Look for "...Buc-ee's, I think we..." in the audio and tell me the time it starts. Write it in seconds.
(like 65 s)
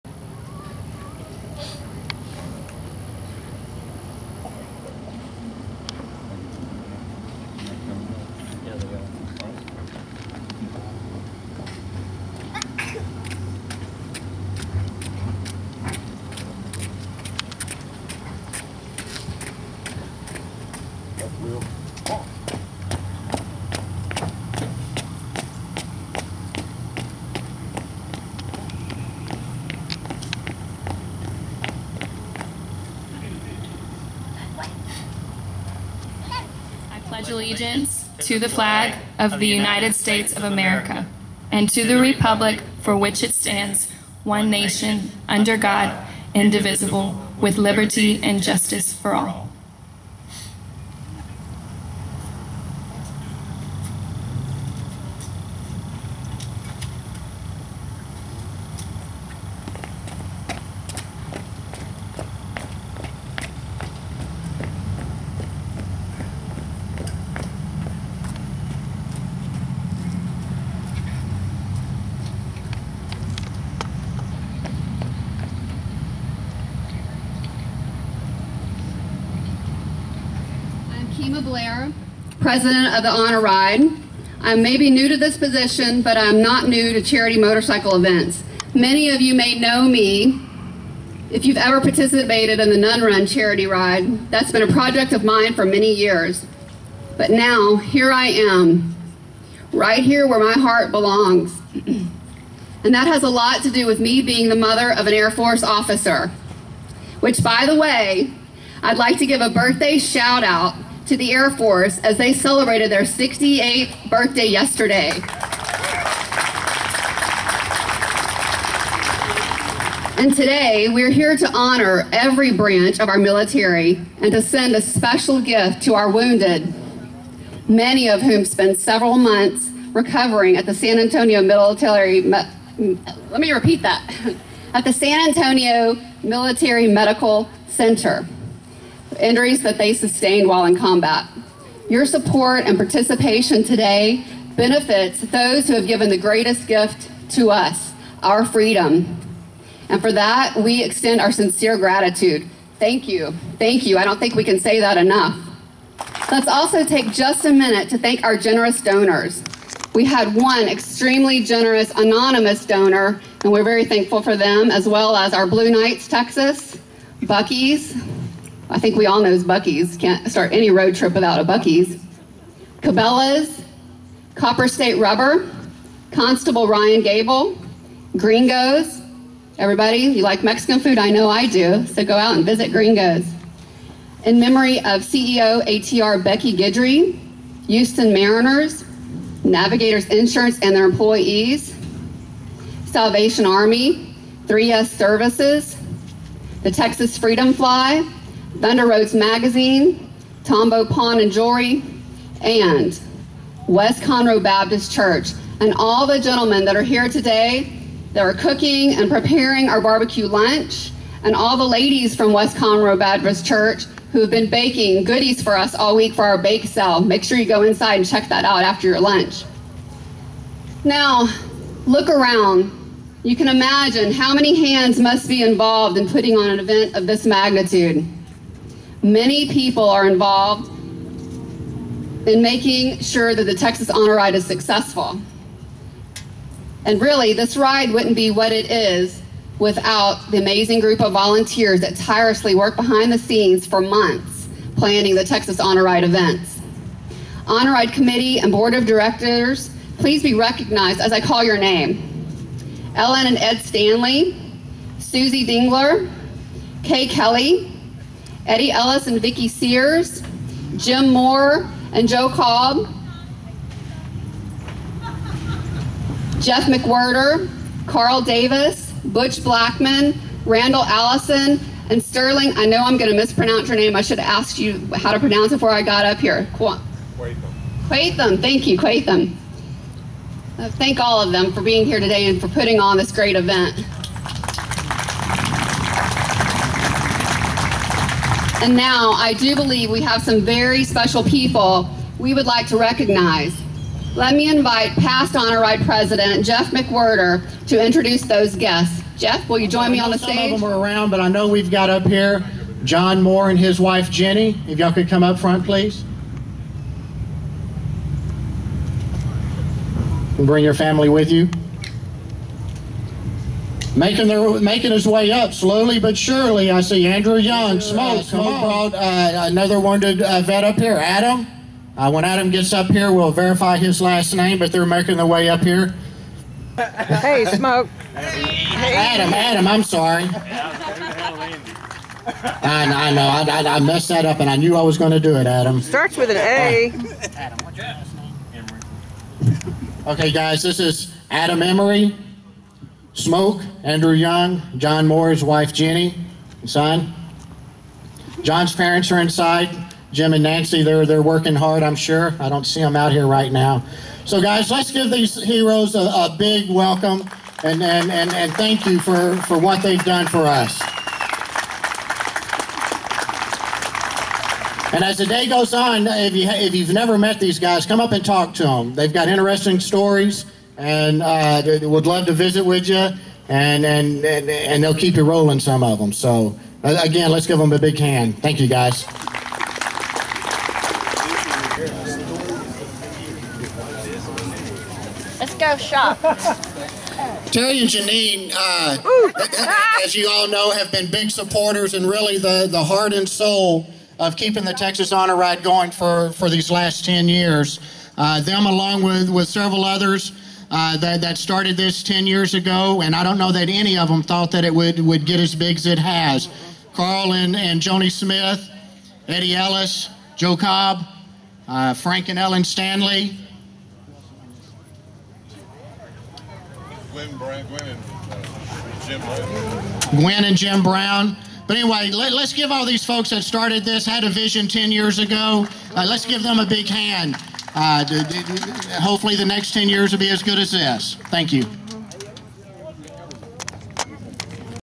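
167 s.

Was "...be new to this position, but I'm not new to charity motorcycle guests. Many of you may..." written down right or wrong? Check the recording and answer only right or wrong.
wrong.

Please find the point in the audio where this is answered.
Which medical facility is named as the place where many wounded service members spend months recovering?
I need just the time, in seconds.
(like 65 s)
134 s.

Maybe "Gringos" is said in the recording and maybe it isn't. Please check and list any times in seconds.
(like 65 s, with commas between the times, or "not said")
178 s, 182 s.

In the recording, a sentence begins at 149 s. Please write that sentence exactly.
And for that, we extend our sincere gratitude.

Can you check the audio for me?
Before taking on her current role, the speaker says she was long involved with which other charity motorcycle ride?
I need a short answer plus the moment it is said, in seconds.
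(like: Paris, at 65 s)
Nun Run, at 92 s.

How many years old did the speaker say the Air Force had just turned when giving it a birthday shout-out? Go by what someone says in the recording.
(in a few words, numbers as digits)
68.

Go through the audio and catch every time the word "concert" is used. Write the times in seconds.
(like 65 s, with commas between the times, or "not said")
not said.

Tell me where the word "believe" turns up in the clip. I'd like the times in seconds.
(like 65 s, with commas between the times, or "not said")
289 s.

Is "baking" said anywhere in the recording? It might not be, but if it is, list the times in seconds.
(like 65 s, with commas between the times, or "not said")
214 s.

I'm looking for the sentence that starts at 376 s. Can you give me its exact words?
So, uh, again, let's give them a big hand.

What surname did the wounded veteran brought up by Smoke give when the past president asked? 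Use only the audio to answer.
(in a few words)
Emery.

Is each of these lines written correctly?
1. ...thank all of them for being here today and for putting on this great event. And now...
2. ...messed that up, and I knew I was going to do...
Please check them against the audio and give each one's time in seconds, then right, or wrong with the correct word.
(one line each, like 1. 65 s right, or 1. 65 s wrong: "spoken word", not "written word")
1. 280 s right
2. 333 s right.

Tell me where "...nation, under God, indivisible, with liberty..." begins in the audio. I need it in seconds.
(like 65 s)
44 s.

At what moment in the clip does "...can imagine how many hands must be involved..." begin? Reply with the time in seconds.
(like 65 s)
223 s.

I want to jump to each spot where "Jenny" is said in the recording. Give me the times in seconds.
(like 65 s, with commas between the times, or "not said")
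304 s, 345 s.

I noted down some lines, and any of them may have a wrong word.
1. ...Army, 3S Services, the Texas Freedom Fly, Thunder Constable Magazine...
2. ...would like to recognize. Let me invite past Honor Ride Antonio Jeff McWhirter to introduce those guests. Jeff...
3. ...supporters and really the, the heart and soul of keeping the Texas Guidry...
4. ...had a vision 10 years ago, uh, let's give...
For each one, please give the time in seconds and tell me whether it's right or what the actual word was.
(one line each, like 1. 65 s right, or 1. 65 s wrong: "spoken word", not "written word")
1. 193 s wrong: "Roads", not "Constable"
2. 292 s wrong: "President", not "Antonio"
3. 391 s wrong: "Honor", not "Guidry"
4. 424 s right.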